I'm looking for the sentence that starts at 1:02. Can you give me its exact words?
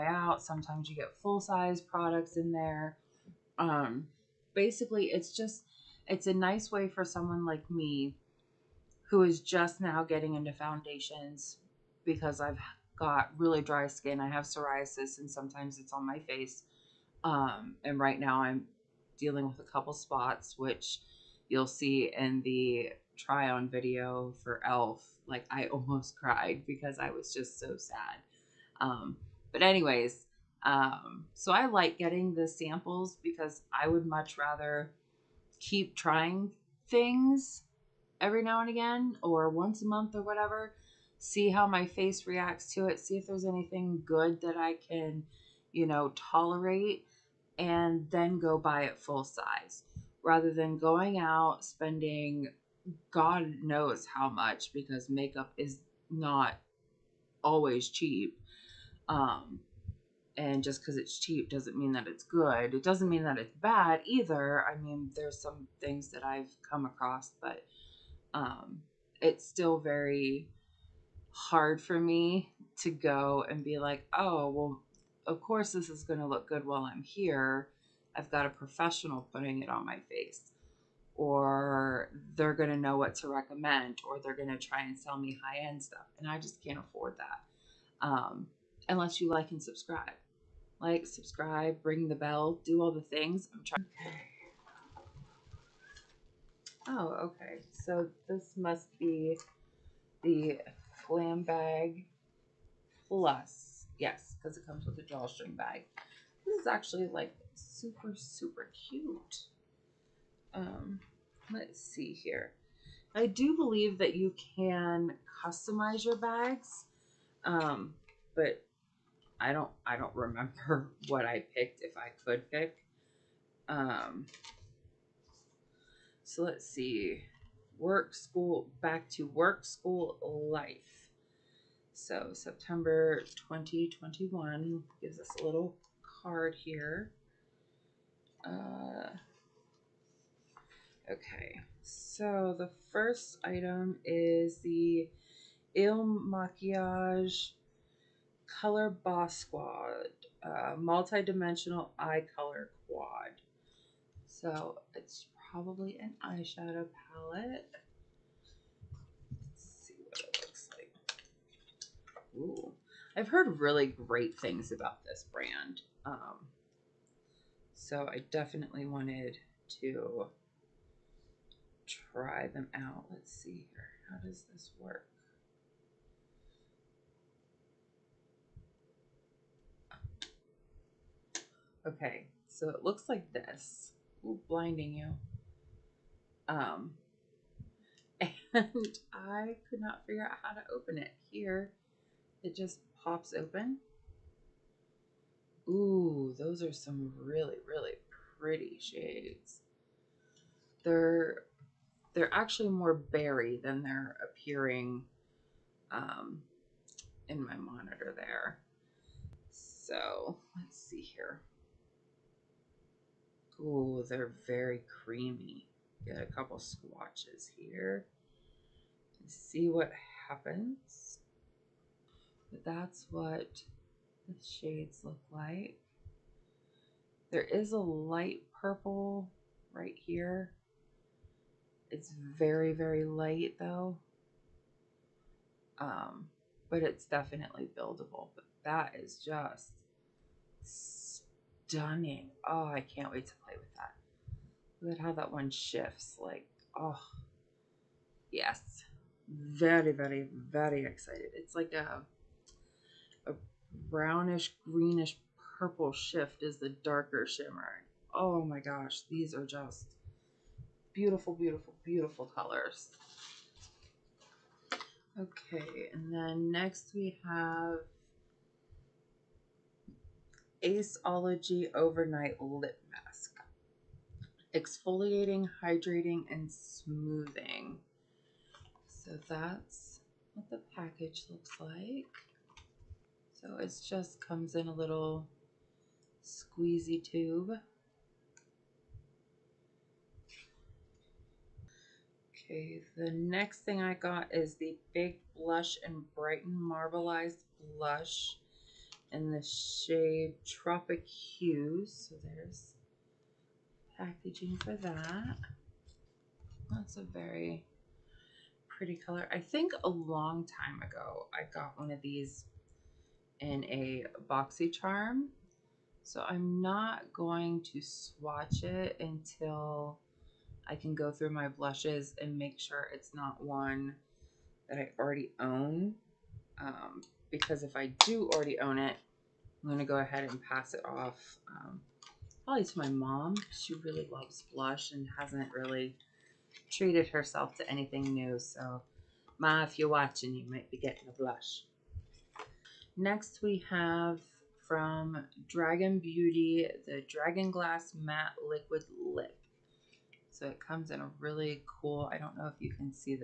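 It doesn't mean that it's bad either.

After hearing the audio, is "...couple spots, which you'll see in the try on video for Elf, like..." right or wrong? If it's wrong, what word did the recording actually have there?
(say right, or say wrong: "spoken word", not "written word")
right.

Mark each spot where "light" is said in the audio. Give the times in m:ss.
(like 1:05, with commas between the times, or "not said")
3:47, 3:53.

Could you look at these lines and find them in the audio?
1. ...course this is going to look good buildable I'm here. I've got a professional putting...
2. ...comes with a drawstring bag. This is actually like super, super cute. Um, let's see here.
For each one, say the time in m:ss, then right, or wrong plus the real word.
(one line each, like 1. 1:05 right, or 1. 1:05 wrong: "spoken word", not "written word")
1. 1:15 wrong: "while", not "buildable"
2. 1:44 right.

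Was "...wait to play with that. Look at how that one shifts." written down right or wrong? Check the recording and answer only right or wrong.
right.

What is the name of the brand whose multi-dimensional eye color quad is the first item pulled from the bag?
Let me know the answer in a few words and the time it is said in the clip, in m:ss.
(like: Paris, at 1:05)
Il Makiage, at 2:25.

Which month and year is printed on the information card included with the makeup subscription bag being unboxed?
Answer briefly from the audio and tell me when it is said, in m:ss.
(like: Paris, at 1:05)
September 2021, at 2:12.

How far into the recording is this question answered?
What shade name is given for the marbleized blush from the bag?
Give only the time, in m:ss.
5:00.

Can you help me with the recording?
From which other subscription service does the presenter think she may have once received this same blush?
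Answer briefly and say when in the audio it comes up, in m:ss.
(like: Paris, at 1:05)
BoxyCharm, at 5:14.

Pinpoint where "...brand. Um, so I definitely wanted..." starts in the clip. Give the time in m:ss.
2:45.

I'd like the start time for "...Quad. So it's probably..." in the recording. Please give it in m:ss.
2:32.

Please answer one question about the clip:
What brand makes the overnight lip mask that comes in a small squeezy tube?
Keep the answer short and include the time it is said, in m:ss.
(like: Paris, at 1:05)
Aceology, at 4:30.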